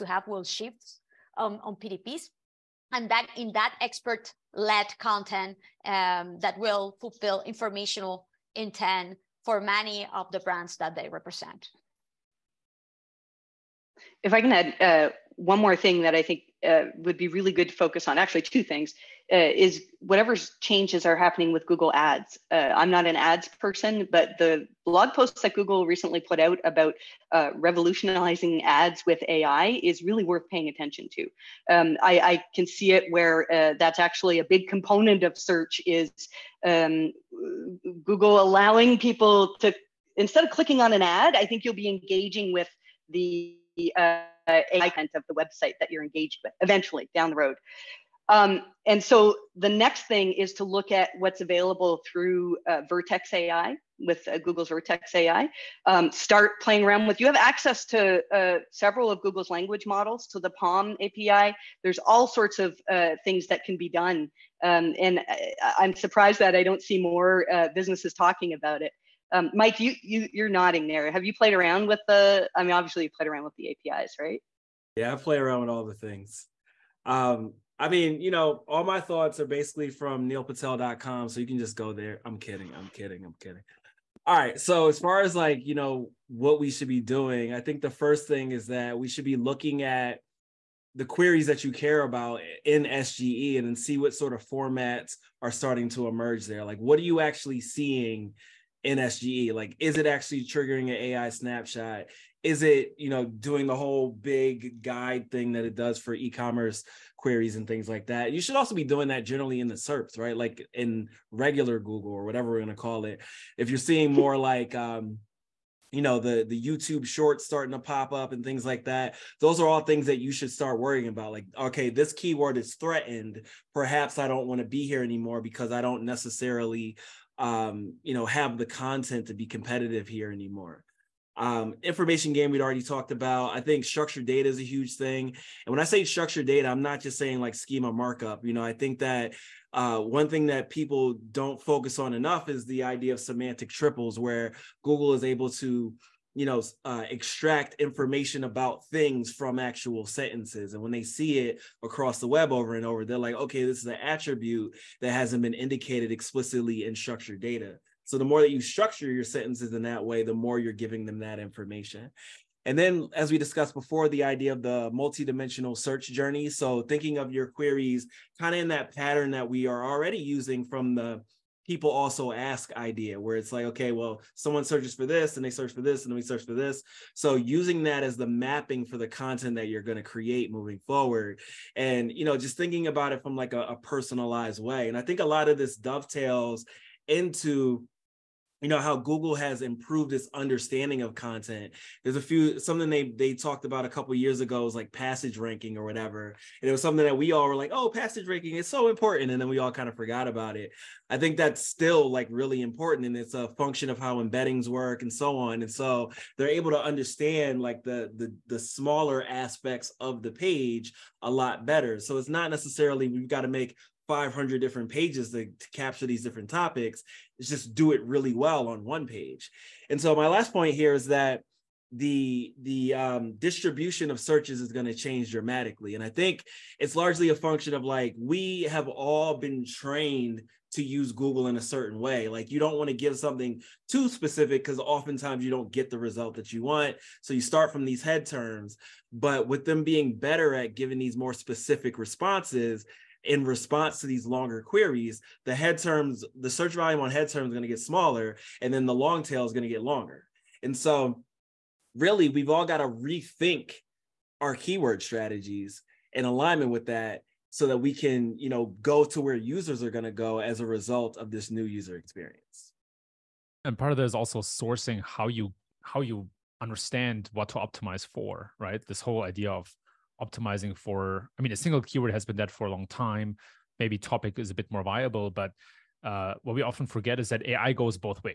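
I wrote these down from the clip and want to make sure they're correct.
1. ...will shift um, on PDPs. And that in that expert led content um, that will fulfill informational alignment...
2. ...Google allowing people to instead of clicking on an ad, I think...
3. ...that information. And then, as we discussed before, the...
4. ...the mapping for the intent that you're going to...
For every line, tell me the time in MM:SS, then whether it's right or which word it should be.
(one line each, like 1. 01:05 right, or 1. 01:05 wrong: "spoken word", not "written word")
1. 00:00 wrong: "intent", not "alignment"
2. 00:38 right
3. 02:41 right
4. 02:58 wrong: "content", not "intent".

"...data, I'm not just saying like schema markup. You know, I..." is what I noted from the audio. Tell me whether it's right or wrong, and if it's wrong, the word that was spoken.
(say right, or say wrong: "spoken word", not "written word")
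right.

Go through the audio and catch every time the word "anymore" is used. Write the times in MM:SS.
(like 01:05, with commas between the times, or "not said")
02:05, 02:10.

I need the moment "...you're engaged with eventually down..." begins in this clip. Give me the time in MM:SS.
00:45.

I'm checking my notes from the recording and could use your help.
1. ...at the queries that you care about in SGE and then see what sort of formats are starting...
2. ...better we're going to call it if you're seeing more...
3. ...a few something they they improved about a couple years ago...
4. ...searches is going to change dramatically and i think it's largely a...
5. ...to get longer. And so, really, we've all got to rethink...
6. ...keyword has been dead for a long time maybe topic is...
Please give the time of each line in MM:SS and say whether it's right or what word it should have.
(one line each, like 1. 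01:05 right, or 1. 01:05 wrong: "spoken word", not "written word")
1. 01:29 right
2. 01:52 wrong: "whatever", not "better"
3. 03:12 wrong: "talked", not "improved"
4. 03:44 right
5. 04:09 right
6. 04:31 right.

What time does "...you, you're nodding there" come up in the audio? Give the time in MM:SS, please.
01:10.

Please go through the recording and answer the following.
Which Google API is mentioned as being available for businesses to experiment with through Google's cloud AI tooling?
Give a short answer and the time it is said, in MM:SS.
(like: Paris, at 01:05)
PaLM API, at 01:00.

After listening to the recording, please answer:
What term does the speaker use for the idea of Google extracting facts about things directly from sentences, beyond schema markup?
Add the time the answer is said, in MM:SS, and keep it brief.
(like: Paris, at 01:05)
semantic triples, at 02:23.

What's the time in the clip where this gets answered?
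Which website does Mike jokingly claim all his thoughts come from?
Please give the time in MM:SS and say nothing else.
01:20.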